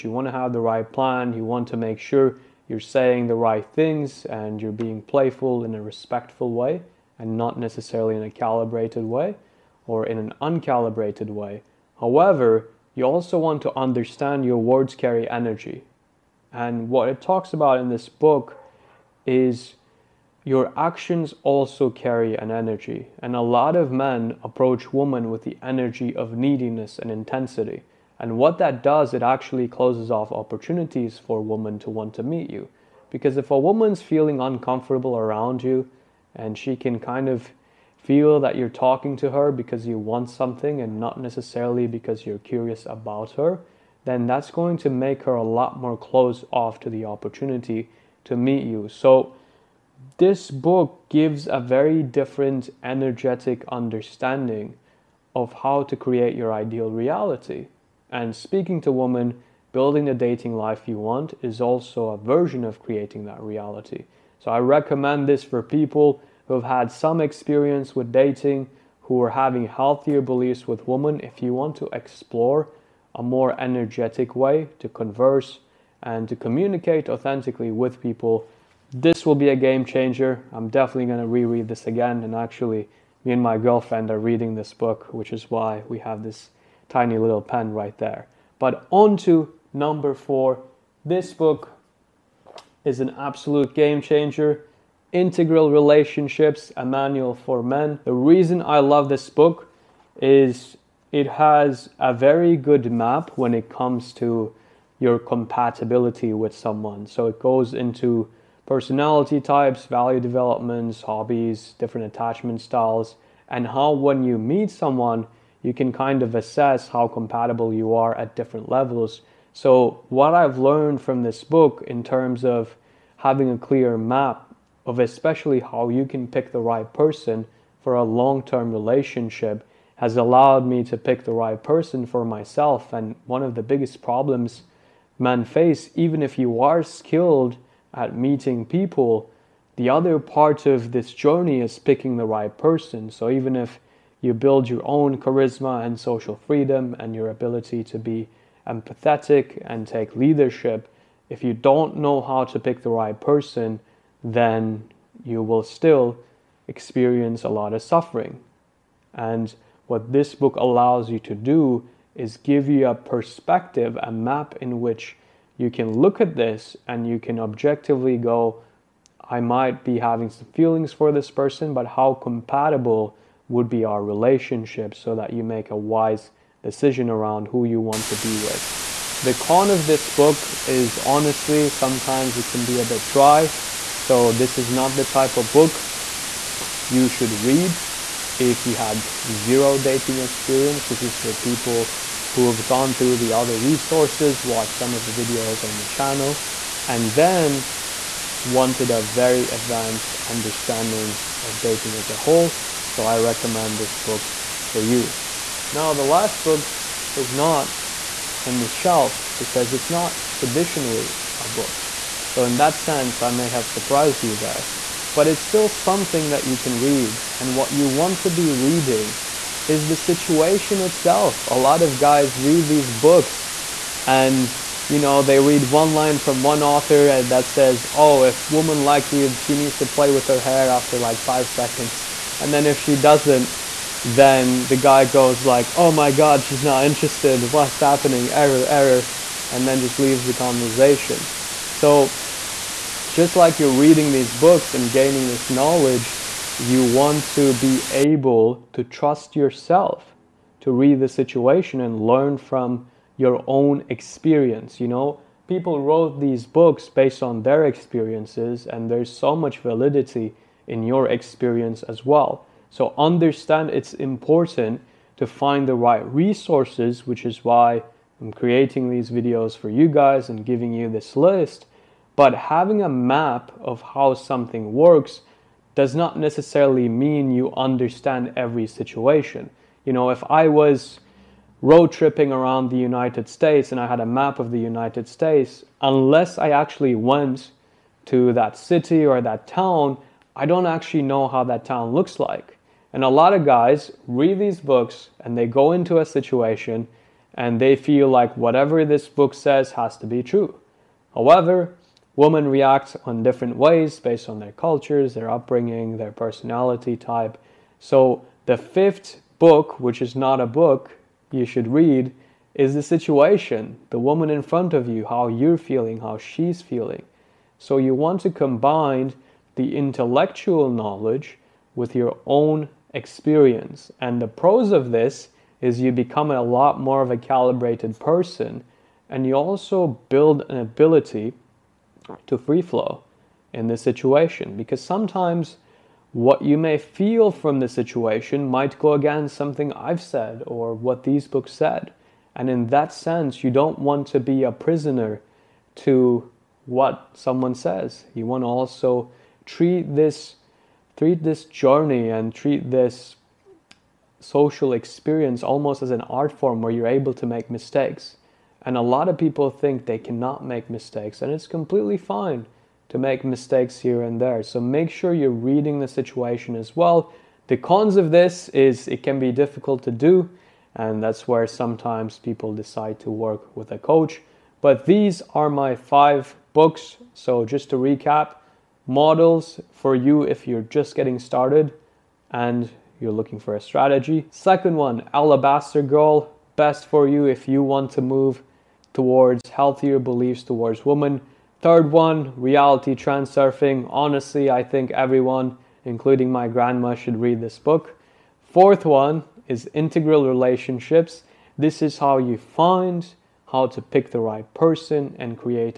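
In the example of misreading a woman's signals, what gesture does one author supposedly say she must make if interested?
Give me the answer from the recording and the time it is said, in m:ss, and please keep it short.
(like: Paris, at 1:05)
Play with her hair, at 3:49.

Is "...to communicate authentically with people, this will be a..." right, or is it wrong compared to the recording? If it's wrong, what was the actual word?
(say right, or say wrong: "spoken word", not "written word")
right.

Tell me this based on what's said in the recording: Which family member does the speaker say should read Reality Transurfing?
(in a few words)
Grandma.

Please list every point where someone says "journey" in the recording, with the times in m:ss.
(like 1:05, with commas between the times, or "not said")
2:21, 5:51.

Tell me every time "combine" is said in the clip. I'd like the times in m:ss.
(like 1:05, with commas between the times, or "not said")
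5:18.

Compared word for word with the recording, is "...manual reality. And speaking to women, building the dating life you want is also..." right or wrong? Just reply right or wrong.
wrong.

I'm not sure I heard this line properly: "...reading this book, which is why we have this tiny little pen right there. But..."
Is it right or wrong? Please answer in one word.
right.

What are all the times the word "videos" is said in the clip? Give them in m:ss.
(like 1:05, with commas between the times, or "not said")
3:15, 4:29.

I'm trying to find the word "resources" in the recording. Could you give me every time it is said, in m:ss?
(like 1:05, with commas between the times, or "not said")
3:13, 4:26.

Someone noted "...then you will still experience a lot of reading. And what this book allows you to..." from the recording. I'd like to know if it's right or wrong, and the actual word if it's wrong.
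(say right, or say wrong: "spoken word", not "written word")
wrong: "suffering", not "reading".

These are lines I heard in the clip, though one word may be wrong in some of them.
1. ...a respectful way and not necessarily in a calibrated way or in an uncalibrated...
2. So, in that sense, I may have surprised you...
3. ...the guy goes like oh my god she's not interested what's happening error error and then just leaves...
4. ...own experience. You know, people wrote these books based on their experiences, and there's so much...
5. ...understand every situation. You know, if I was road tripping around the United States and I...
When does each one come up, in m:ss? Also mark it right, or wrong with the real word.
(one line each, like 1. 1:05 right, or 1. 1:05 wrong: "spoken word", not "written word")
1. 0:05 right
2. 3:32 right
3. 3:54 right
4. 4:13 right
5. 4:37 right.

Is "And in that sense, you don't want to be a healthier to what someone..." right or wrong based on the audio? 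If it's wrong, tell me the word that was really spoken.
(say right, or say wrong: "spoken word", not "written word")
wrong: "prisoner", not "healthier".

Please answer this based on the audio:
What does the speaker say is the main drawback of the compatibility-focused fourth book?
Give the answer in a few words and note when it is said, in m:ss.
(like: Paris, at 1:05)
Dry, at 3:03.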